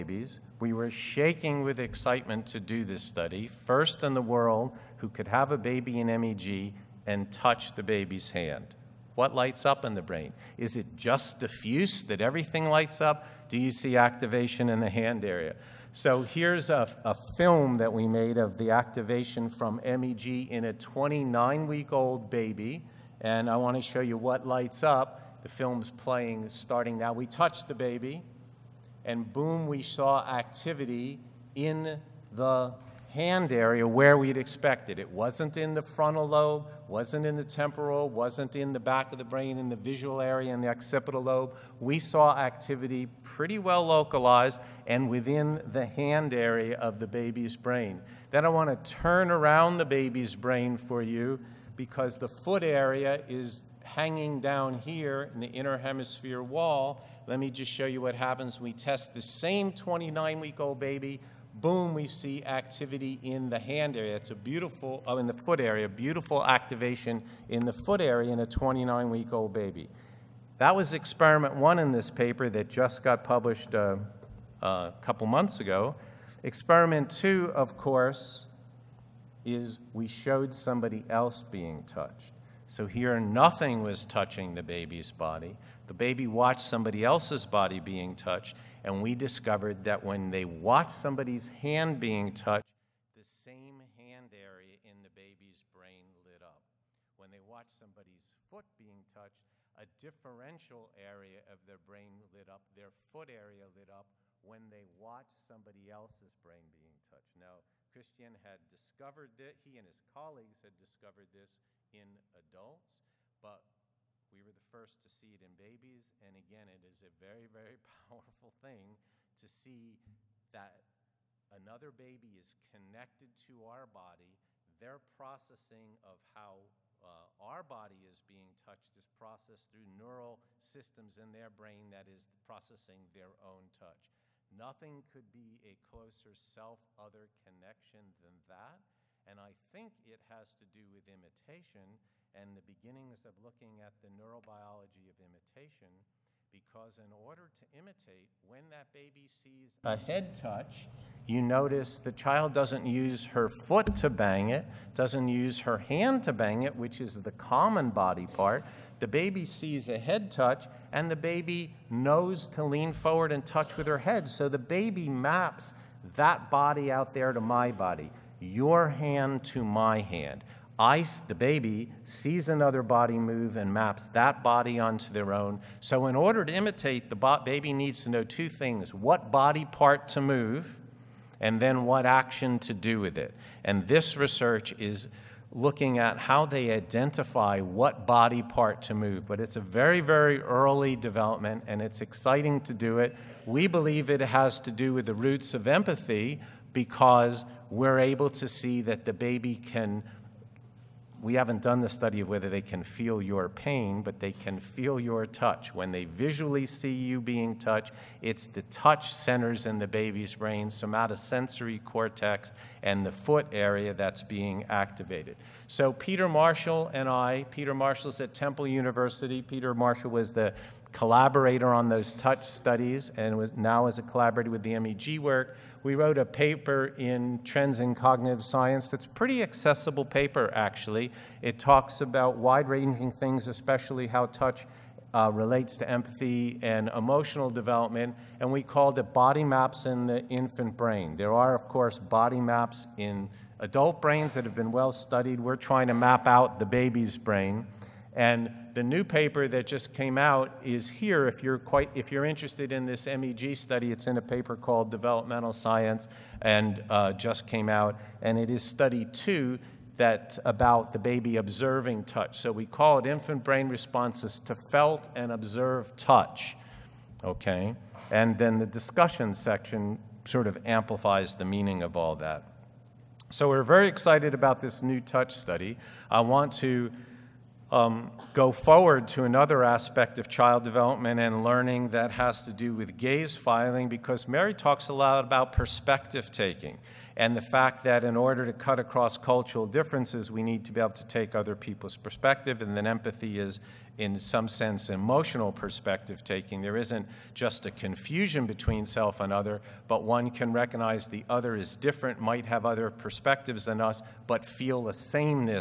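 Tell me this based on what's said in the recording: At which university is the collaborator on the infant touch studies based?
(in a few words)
Temple University.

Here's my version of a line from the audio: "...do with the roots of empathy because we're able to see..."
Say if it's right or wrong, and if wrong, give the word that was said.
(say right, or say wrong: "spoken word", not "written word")
right.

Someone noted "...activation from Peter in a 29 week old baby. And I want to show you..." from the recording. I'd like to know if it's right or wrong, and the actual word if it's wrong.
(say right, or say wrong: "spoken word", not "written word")
wrong: "MEG", not "Peter".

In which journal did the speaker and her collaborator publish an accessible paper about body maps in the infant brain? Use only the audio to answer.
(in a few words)
Trends in Cognitive Science.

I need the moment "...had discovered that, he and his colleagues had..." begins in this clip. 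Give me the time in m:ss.
1:48.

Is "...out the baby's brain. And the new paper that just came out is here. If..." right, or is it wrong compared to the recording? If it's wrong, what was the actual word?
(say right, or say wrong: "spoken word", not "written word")
right.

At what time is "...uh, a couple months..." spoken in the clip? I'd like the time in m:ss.
1:13.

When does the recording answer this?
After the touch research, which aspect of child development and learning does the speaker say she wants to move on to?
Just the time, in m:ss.
4:42.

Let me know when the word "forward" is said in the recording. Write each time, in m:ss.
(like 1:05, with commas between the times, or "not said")
2:42, 4:38.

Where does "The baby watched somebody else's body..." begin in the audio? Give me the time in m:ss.
1:25.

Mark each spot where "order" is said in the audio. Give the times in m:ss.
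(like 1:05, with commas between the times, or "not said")
2:27, 2:56, 4:48.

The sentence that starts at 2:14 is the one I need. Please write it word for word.
Nothing could be a closer self other connection than that.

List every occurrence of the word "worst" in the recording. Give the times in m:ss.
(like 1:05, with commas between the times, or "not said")
not said.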